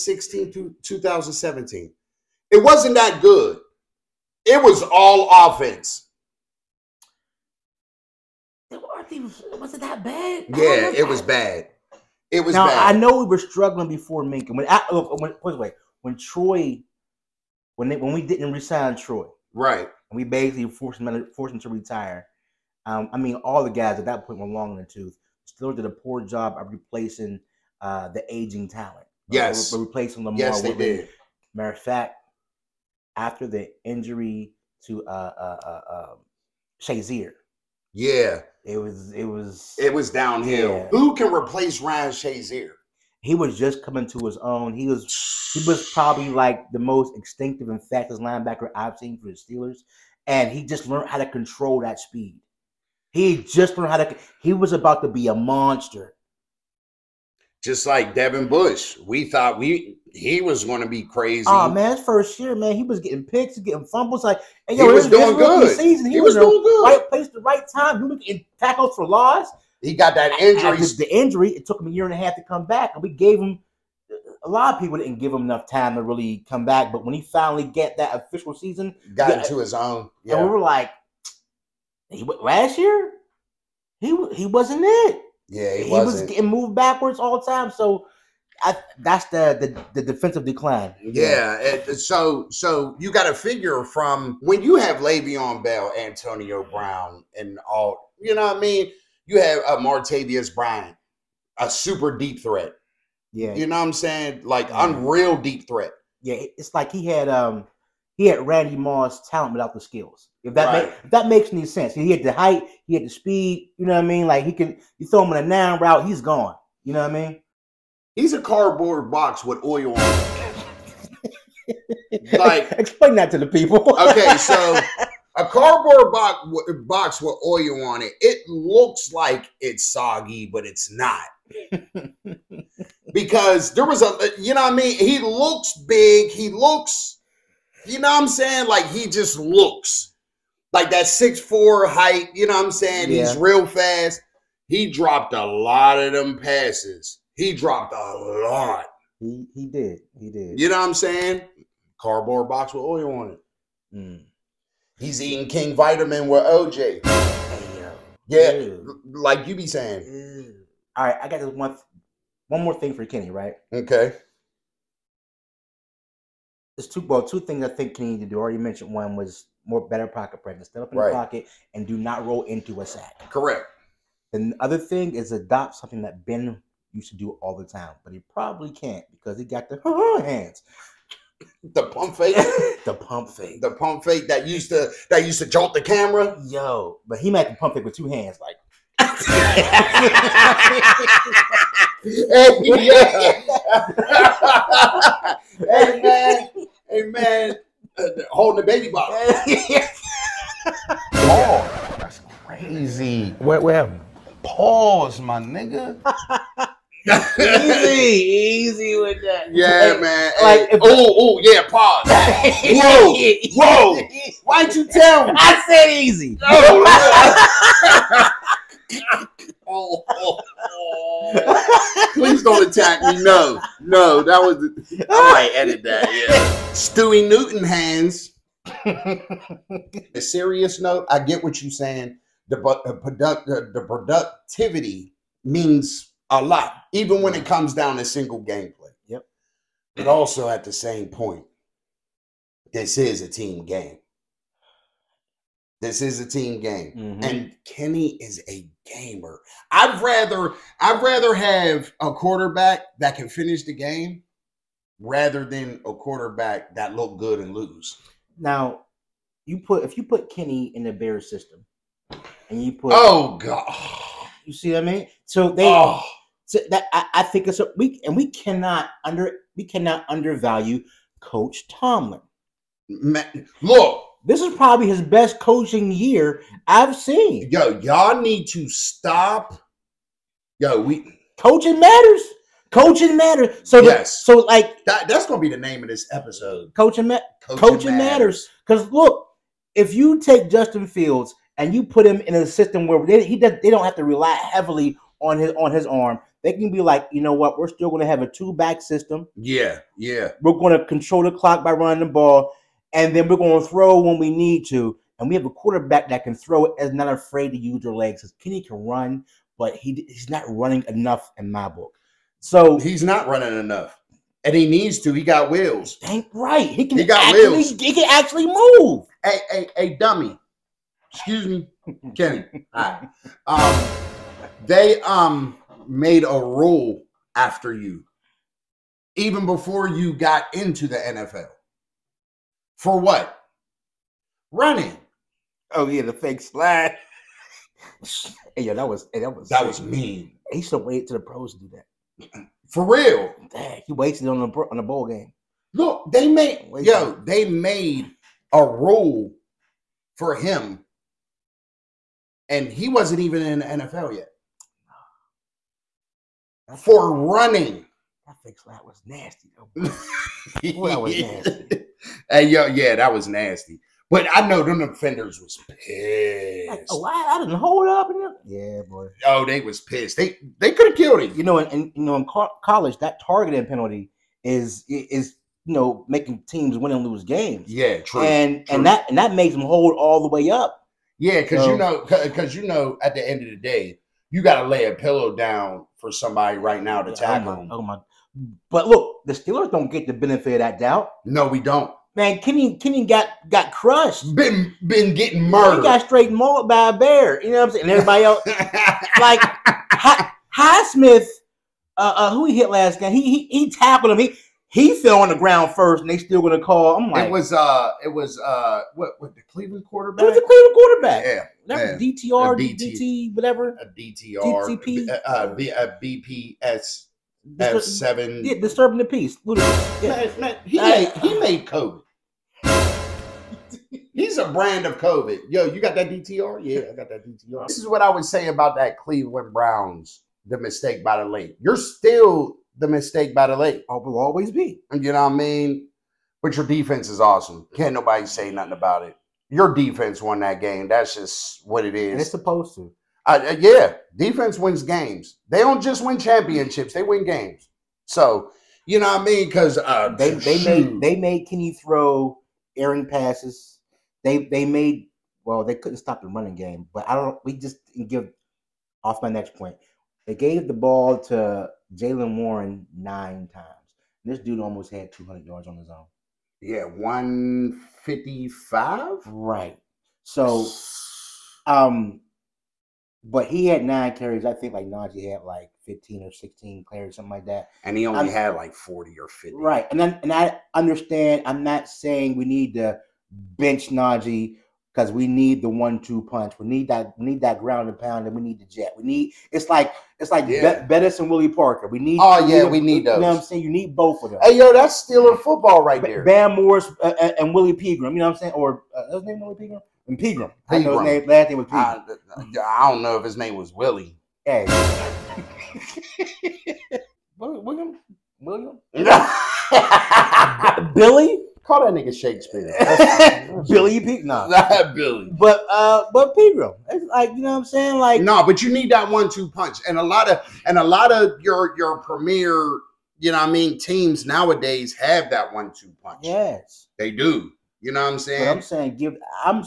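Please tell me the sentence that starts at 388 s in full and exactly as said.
But look, the Steelers don't get the benefit of that doubt.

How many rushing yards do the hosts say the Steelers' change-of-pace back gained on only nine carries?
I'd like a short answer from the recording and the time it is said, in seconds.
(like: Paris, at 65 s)
155, at 466 s.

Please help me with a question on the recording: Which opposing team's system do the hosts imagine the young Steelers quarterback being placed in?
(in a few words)
Bears.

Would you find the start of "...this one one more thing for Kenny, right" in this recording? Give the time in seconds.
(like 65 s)
161 s.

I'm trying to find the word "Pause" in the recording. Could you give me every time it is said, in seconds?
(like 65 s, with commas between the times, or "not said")
204 s, 211 s.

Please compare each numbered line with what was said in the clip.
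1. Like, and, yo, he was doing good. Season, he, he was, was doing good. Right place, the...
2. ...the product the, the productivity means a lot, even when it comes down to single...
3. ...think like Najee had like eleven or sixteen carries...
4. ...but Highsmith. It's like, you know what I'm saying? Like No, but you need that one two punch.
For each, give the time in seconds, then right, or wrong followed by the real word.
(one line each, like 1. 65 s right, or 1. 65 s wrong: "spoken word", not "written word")
1. 64 s right
2. 232 s right
3. 474 s wrong: "fifteen", not "eleven"
4. 516 s wrong: "Pegram", not "Highsmith".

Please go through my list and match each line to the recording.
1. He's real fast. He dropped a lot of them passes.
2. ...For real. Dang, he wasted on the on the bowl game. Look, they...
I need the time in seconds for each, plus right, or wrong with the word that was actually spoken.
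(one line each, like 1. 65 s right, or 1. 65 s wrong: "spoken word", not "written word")
1. 143 s right
2. 342 s right.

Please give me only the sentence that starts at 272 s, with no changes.
Man, look this is probably his best coaching year I've seen.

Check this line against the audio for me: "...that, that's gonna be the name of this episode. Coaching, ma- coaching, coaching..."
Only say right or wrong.
right.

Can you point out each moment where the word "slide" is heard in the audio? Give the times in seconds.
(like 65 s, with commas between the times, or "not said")
336 s, 358 s.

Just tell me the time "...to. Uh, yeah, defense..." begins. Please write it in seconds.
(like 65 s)
442 s.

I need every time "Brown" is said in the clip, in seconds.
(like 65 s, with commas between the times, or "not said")
96 s, 429 s.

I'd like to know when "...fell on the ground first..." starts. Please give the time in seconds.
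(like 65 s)
405 s.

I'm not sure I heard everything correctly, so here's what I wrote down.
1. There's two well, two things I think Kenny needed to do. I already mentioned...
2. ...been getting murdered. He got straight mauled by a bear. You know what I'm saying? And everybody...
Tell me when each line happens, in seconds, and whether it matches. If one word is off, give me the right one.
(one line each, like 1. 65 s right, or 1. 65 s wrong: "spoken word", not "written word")
1. 166 s right
2. 394 s right.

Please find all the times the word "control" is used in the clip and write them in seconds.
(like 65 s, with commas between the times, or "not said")
51 s, 300 s.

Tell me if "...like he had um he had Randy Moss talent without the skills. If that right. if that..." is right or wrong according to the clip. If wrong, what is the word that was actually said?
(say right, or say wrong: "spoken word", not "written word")
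right.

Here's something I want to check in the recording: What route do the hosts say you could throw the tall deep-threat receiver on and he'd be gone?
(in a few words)
nine route.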